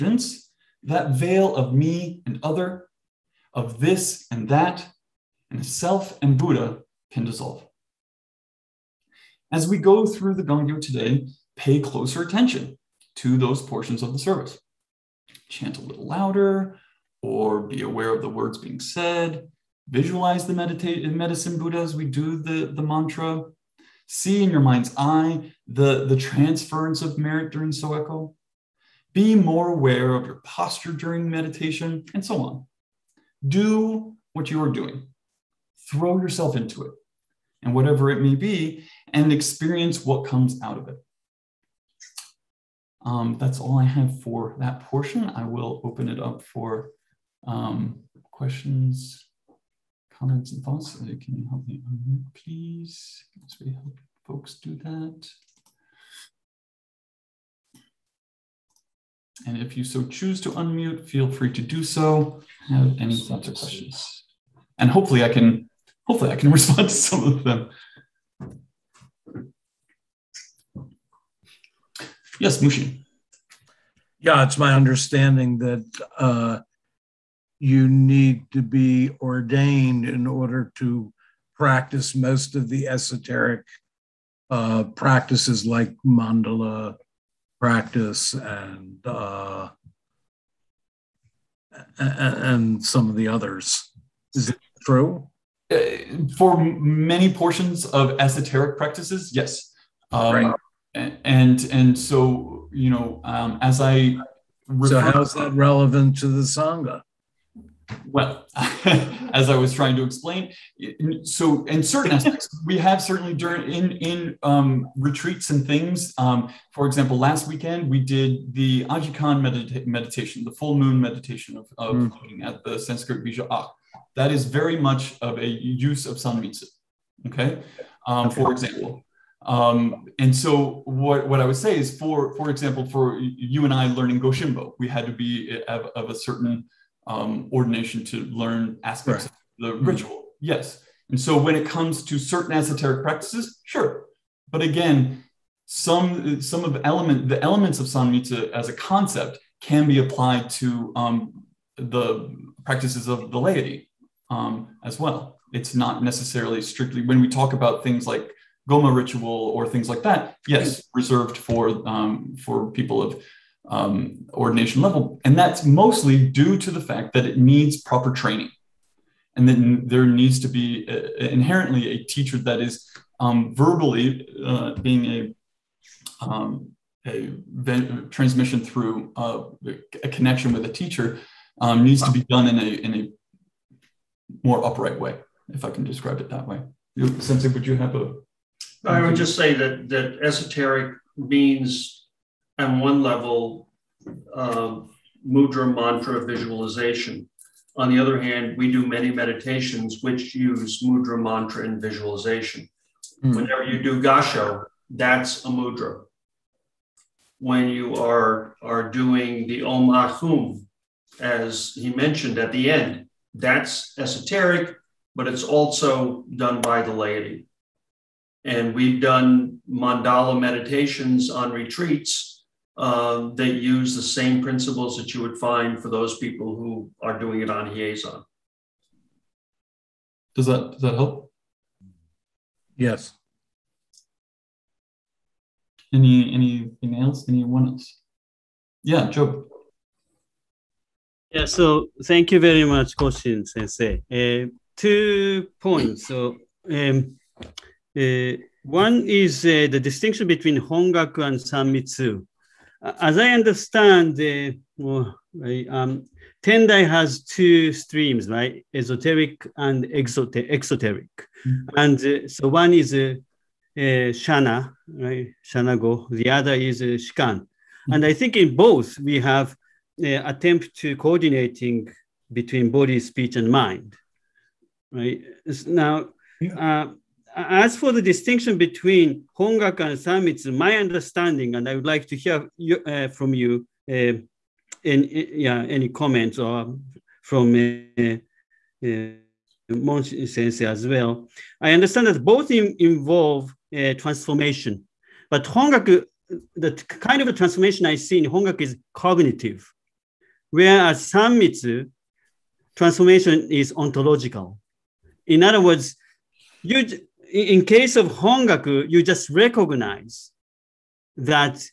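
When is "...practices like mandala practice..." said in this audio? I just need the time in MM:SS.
01:24.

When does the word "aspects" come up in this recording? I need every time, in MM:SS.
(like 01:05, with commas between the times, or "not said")
01:52, 02:18.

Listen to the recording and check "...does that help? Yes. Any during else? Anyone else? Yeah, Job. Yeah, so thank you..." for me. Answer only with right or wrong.
wrong.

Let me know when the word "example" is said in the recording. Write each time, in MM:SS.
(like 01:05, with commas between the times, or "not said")
01:56, 02:08, 02:12.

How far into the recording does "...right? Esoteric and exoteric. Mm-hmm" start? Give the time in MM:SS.
04:18.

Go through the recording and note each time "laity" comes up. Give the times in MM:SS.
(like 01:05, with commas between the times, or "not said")
02:33, 03:36.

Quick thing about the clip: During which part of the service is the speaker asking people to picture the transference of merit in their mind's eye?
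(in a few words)
Soeko.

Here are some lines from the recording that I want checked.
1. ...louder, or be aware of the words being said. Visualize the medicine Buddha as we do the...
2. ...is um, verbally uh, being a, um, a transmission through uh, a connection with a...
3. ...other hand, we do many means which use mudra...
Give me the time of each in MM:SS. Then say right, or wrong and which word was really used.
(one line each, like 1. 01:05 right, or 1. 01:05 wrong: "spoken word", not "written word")
1. 00:16 right
2. 02:52 right
3. 03:17 wrong: "meditations", not "means".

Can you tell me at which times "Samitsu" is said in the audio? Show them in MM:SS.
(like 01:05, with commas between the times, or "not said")
04:39, 05:01.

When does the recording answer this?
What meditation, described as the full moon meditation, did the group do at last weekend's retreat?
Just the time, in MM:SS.
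01:58.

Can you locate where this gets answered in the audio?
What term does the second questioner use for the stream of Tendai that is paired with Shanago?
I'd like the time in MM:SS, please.
04:26.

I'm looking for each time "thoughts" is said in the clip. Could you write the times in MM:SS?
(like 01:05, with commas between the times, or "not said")
00:50, 01:03.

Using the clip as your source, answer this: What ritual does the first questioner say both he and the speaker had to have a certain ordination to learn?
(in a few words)
Goshimbo.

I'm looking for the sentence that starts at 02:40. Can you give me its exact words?
reserved for um, for people of um, ordination level.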